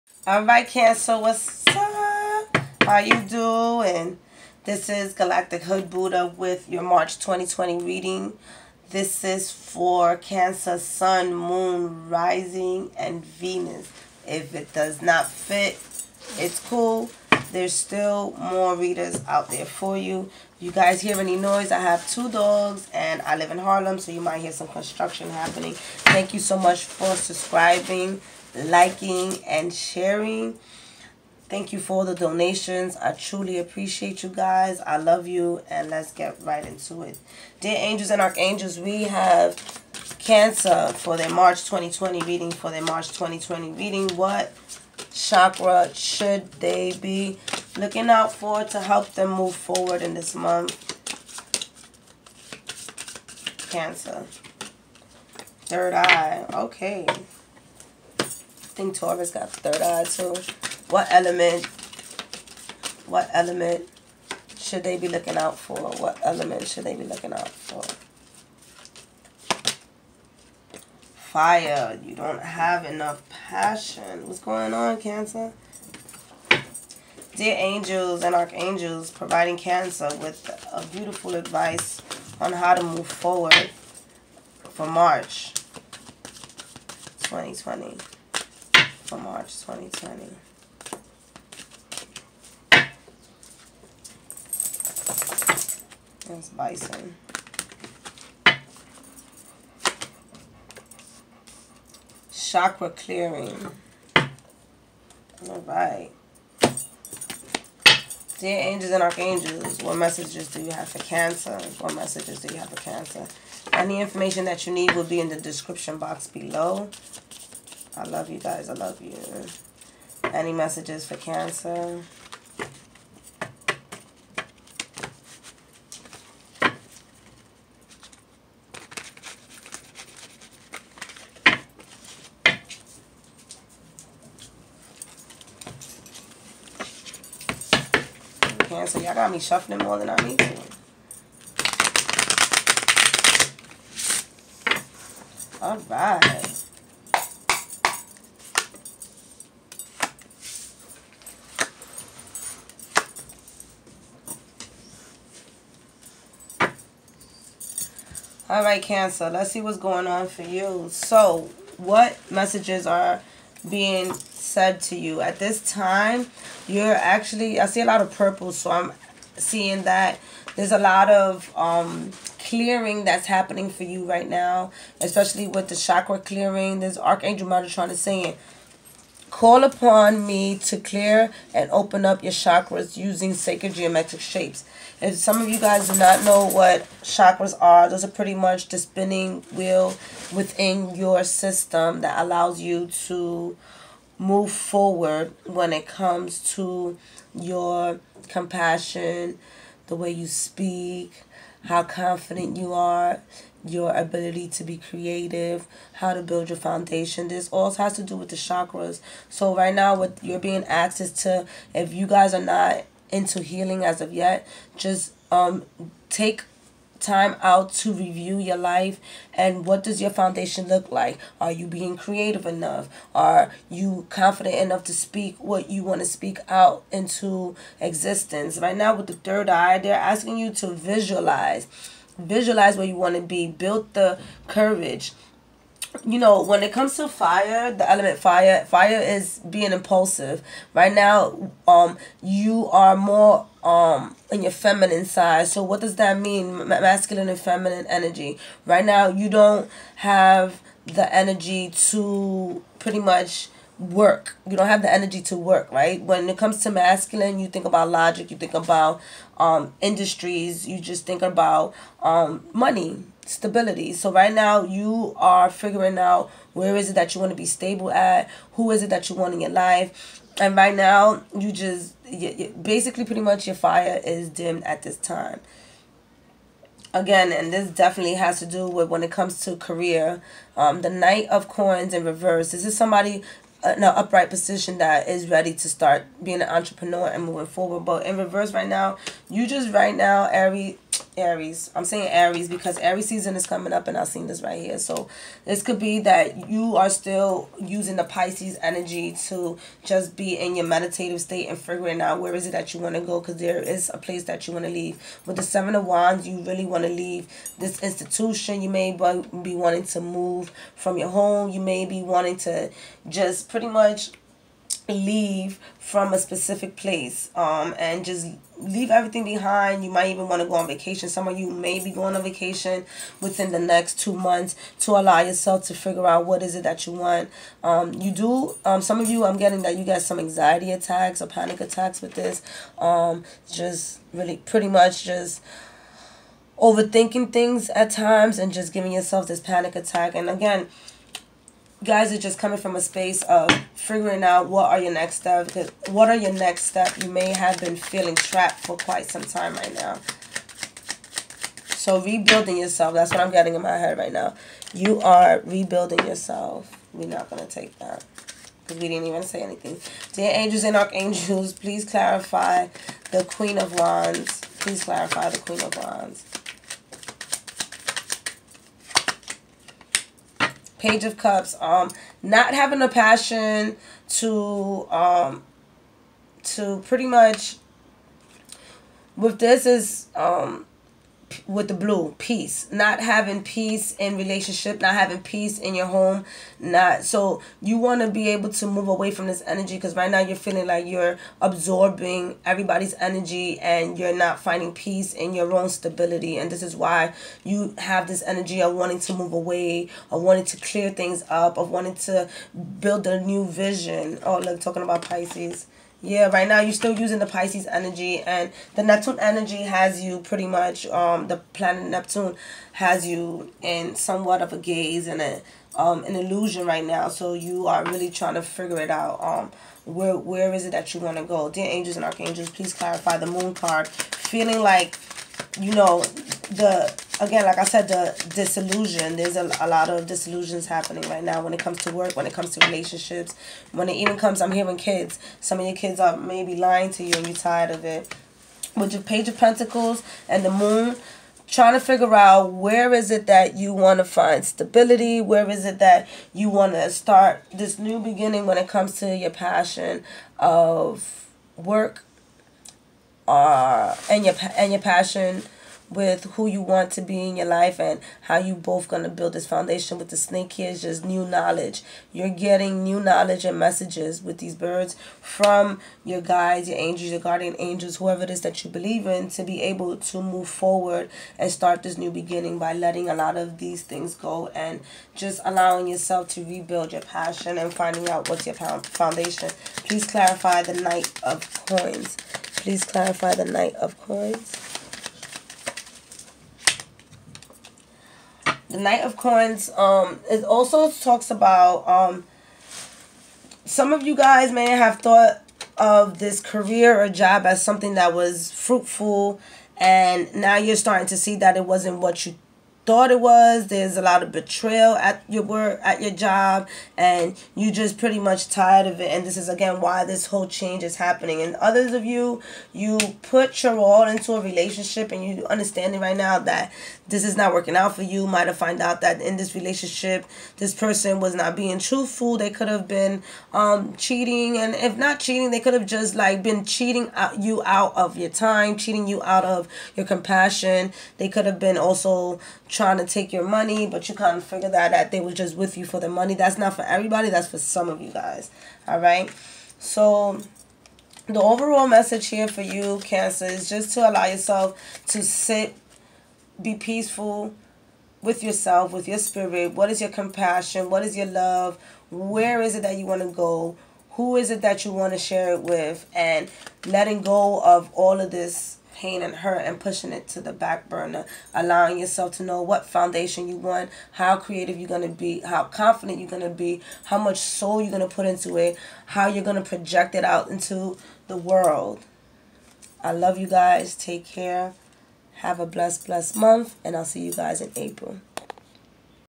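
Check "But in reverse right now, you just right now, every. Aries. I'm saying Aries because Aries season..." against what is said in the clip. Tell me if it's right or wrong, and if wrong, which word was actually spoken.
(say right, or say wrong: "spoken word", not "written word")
right.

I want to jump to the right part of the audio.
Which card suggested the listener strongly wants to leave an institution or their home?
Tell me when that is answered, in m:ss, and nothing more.
5:05.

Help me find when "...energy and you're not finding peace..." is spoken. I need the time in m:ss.
6:32.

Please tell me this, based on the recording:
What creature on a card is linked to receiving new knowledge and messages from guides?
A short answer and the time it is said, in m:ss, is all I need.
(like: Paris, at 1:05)
Snake, at 7:40.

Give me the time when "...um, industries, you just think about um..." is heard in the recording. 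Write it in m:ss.
4:19.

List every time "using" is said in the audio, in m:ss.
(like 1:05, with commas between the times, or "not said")
3:02, 4:57, 6:46.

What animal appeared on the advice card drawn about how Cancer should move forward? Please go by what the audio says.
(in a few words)
Bison.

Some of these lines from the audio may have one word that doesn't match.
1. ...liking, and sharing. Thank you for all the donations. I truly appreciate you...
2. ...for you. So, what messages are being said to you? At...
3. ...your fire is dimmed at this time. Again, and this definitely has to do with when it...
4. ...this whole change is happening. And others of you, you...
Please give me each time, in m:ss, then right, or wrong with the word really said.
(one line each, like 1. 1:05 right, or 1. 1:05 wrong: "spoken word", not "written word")
1. 0:28 right
2. 2:40 right
3. 4:33 right
4. 8:30 right.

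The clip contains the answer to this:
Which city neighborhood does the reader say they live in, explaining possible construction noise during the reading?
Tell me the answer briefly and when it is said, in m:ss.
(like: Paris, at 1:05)
Harlem, at 0:23.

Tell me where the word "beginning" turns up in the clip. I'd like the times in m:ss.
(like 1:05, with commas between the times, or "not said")
7:27, 7:52.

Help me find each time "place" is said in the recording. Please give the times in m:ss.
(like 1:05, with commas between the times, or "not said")
5:03, 5:16.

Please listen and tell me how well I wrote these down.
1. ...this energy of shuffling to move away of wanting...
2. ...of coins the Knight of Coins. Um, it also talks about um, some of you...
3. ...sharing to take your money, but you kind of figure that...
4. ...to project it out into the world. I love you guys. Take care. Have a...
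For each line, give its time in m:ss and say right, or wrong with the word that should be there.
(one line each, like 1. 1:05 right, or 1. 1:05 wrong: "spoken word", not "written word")
1. 6:38 wrong: "wanting", not "shuffling"
2. 8:03 right
3. 8:52 wrong: "trying", not "sharing"
4. 9:29 right.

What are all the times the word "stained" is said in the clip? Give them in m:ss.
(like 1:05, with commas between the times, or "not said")
not said.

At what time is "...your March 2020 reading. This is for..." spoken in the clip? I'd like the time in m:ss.
0:06.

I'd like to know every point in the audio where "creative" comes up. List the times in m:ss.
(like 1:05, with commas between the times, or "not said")
3:24, 3:41, 9:24.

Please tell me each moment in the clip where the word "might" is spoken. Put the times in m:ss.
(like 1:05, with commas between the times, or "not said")
0:24, 5:19, 8:38.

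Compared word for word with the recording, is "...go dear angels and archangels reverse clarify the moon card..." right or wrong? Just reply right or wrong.
wrong.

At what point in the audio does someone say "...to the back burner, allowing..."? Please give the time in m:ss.
9:20.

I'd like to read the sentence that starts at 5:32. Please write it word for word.
Um, just really pretty much just overthinking things at times and just giving yourself this panic attack.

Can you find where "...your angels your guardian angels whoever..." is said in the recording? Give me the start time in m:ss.
7:46.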